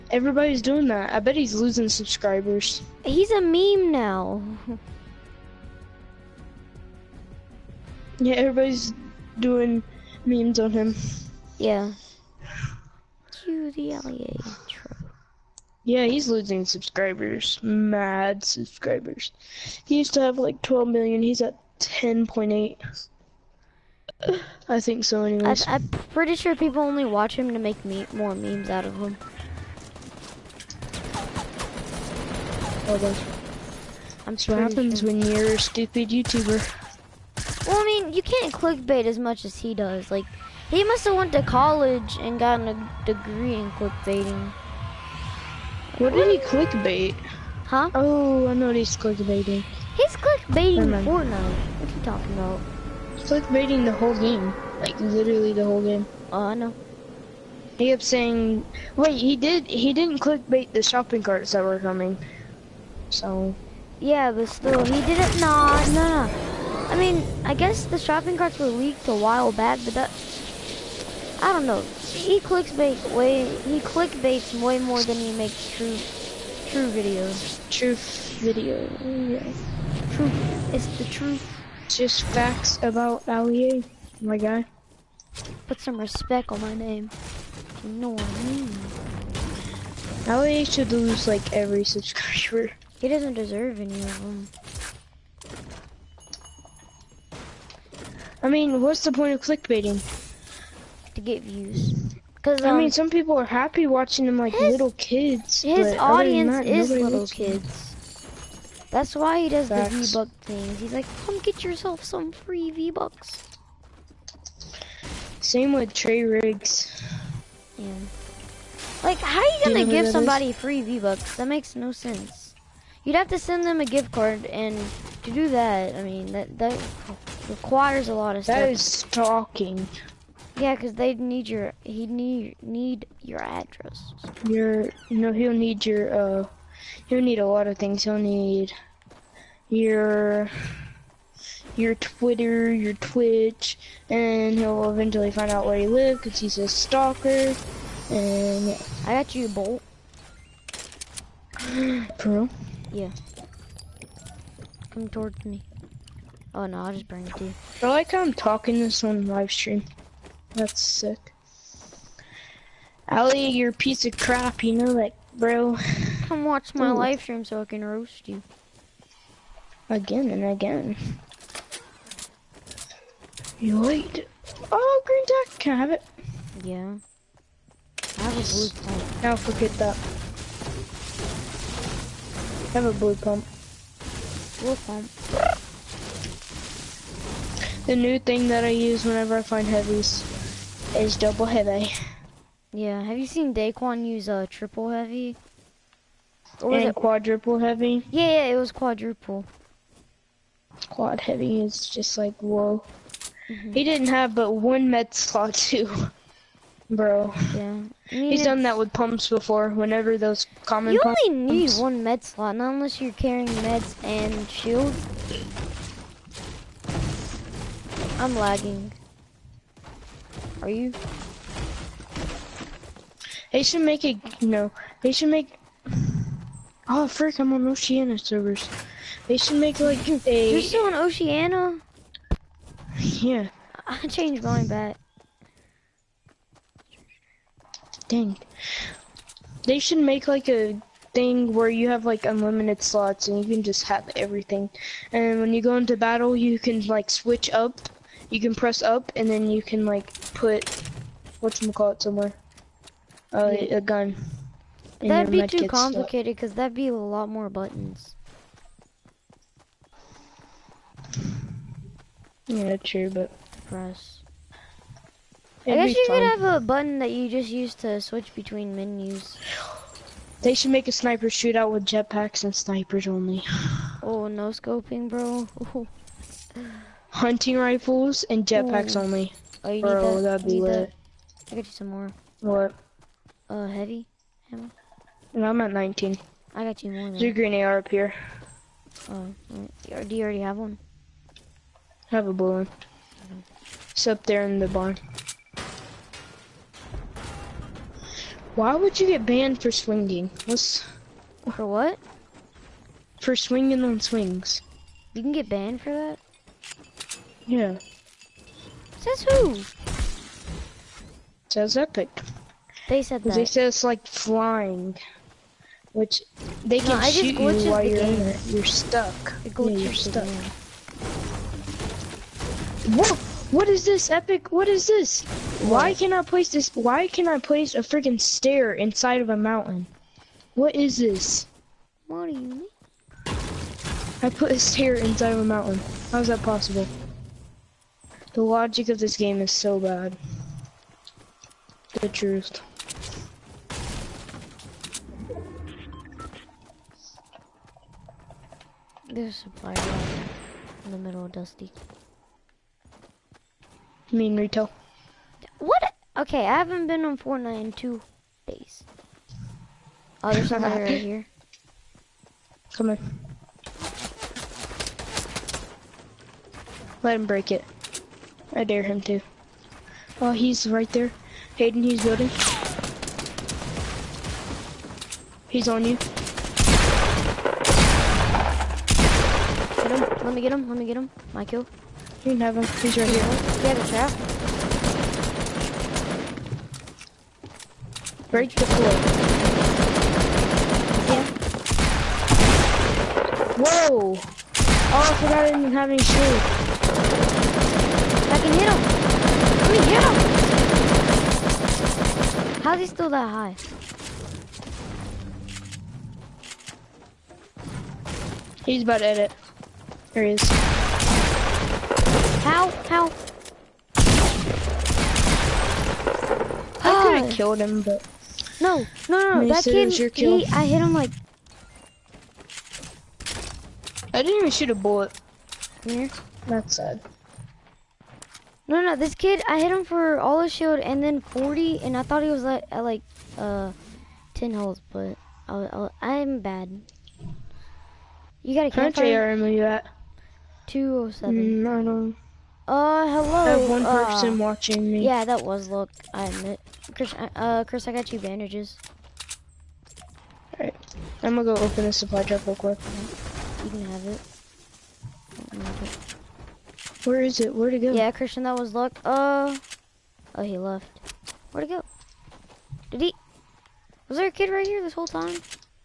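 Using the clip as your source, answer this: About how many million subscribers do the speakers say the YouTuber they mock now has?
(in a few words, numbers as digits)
10.8.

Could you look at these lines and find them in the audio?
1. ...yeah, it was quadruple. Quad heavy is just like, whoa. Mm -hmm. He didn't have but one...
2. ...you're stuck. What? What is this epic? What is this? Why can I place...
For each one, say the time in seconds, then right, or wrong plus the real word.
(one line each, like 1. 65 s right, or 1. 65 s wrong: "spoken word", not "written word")
1. 198 s right
2. 319 s right.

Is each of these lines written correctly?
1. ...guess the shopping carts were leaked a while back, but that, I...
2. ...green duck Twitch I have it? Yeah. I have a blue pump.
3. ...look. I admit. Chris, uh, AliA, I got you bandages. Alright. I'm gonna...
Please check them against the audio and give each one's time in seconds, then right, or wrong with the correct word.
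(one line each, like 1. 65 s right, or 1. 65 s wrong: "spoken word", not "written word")
1. 67 s right
2. 175 s wrong: "Can", not "Twitch"
3. 445 s wrong: "Chris", not "AliA".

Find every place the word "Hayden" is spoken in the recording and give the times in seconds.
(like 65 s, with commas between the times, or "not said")
371 s.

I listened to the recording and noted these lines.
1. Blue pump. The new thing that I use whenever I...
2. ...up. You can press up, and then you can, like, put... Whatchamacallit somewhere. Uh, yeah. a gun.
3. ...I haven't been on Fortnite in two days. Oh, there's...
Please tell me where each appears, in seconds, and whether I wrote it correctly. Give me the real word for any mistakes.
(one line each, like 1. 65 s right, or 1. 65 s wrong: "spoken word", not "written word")
1. 184 s right
2. 247 s right
3. 356 s right.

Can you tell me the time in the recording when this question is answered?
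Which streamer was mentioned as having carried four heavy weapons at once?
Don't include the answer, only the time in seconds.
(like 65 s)
193 s.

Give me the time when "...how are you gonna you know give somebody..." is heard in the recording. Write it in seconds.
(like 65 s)
119 s.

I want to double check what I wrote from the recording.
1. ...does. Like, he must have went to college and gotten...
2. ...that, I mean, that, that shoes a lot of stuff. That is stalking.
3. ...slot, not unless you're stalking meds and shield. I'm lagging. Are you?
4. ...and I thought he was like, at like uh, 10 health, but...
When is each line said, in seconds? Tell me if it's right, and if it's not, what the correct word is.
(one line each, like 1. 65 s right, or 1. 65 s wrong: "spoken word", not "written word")
1. 39 s right
2. 125 s wrong: "requires", not "shoes"
3. 212 s wrong: "carrying", not "stalking"
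4. 431 s right.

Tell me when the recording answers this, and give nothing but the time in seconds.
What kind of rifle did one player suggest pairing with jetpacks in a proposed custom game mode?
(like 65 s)
277 s.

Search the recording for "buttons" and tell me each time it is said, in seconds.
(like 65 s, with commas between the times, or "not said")
257 s, 266 s.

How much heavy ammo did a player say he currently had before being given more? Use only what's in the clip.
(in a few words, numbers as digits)
19.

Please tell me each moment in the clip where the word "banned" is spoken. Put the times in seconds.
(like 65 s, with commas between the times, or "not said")
299 s, 305 s.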